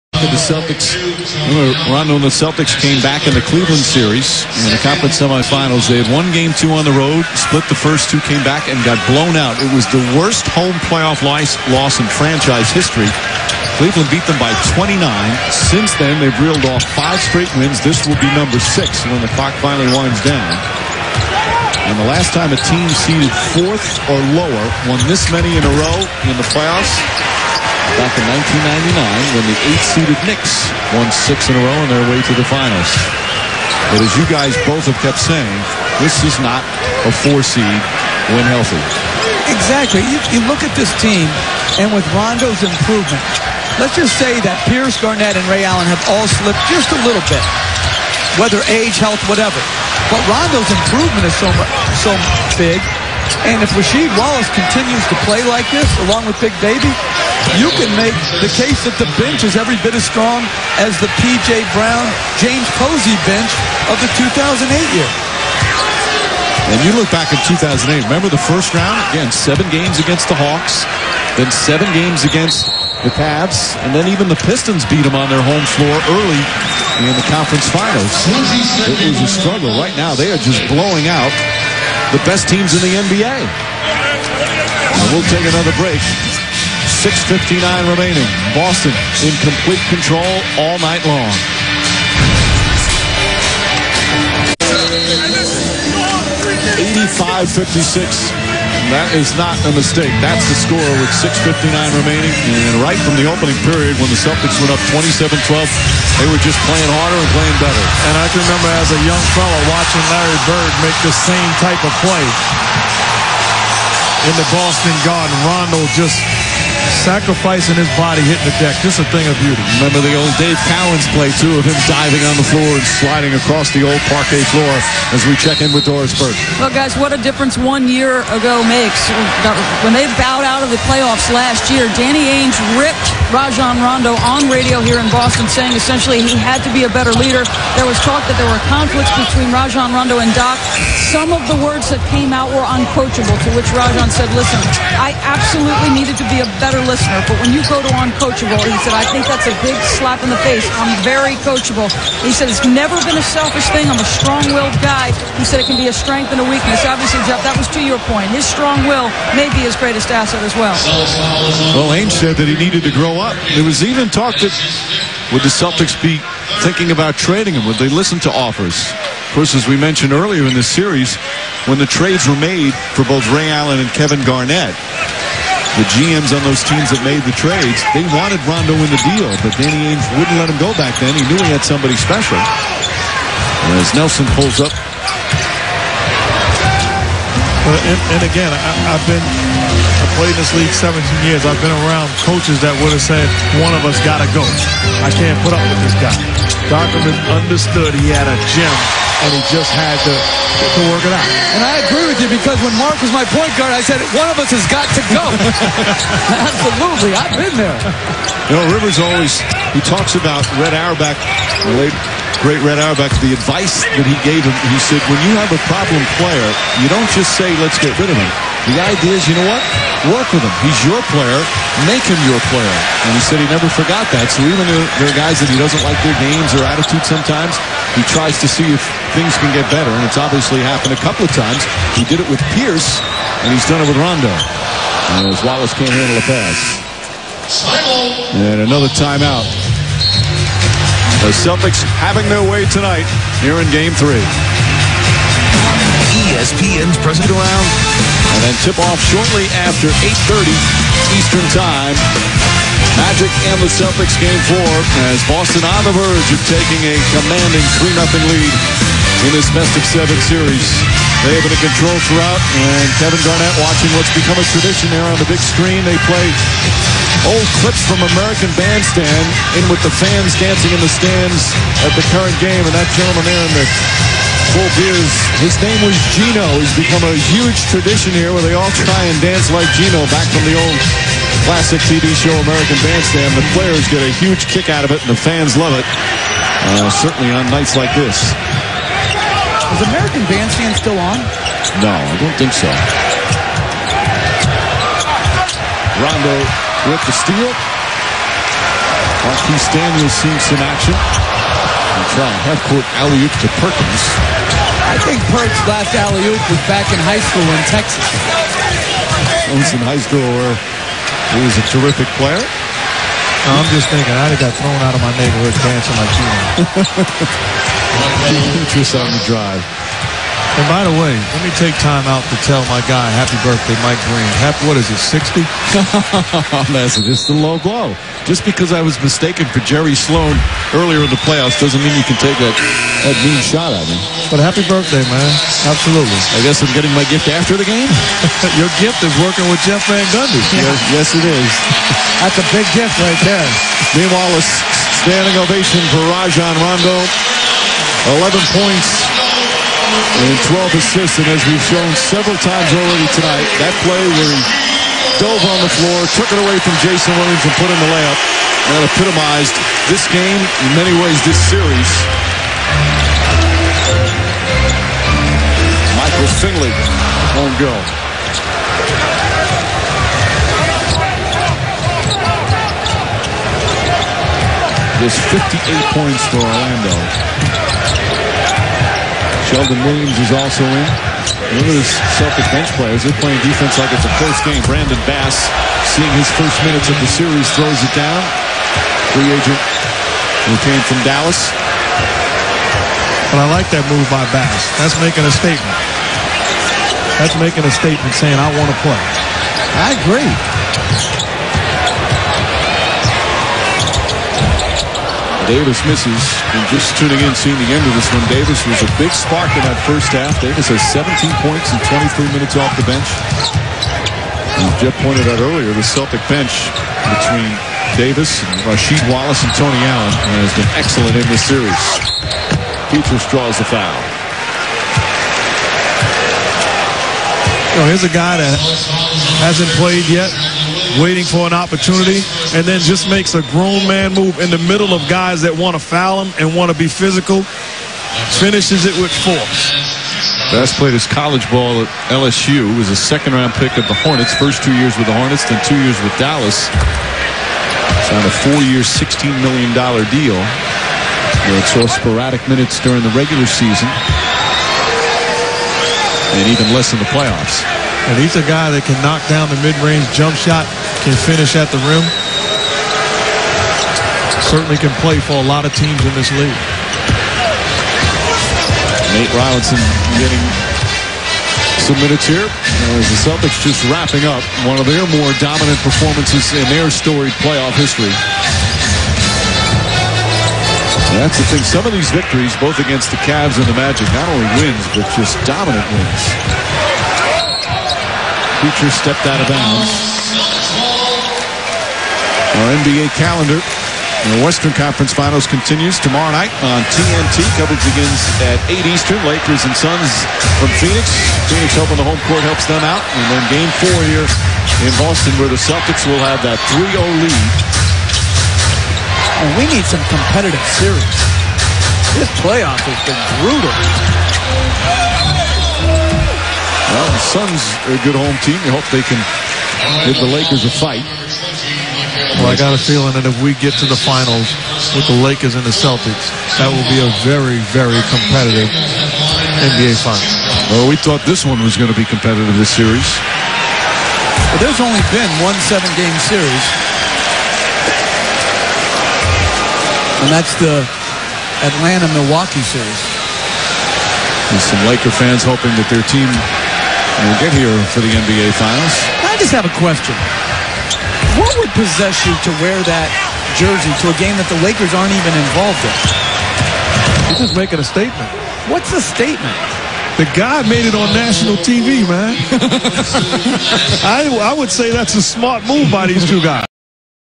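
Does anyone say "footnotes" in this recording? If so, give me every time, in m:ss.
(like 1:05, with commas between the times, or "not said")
not said.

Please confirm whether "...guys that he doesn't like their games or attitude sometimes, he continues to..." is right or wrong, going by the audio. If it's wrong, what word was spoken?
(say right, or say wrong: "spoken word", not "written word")
wrong: "tries", not "continues".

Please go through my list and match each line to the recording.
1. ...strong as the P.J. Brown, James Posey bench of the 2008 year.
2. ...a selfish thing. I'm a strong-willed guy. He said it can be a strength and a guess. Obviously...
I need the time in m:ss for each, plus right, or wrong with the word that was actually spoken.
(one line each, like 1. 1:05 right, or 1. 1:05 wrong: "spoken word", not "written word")
1. 1:00 right
2. 2:33 wrong: "weakness", not "guess".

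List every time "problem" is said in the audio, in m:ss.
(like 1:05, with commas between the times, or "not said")
3:35.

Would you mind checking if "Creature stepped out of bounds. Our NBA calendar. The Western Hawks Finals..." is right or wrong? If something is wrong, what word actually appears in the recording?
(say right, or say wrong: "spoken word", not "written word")
wrong: "Conference", not "Hawks".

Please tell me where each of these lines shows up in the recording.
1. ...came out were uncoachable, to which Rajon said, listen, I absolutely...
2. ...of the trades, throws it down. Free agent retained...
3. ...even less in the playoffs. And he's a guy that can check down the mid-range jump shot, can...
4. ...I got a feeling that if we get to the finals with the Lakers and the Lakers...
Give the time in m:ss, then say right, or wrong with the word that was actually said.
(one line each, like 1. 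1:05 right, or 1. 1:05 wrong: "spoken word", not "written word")
1. 2:22 right
2. 6:26 wrong: "series", not "trades"
3. 7:36 wrong: "knock", not "check"
4. 8:42 wrong: "Celtics", not "Lakers".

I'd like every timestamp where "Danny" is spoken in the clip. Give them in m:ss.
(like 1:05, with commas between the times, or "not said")
2:11, 2:59.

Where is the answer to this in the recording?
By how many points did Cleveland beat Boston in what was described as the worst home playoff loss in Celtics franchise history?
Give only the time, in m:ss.
0:13.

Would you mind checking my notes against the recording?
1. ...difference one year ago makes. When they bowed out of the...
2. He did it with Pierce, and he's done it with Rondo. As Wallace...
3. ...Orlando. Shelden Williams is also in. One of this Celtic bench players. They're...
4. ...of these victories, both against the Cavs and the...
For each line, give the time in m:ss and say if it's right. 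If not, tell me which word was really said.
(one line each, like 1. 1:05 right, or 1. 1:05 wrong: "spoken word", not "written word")
1. 2:07 right
2. 3:51 right
3. 6:16 right
4. 8:01 right.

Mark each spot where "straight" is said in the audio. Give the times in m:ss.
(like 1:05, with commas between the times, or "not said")
0:17.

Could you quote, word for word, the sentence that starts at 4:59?
Marquis Daniels seeing some action half-court alley-oop to Perkins.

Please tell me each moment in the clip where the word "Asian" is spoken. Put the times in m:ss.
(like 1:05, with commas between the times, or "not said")
not said.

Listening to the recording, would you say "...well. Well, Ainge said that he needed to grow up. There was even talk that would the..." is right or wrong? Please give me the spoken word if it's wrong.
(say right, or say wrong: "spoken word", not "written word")
right.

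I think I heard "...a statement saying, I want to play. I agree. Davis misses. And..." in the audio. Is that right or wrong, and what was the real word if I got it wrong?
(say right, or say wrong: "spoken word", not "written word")
right.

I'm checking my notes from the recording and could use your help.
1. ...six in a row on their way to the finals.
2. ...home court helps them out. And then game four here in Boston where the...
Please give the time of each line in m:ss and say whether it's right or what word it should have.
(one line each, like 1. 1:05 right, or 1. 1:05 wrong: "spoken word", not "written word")
1. 0:31 right
2. 8:22 right.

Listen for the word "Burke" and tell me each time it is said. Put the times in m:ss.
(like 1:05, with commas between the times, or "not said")
2:06.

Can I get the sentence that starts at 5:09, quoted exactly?
Owns in high school where he was a terrific player.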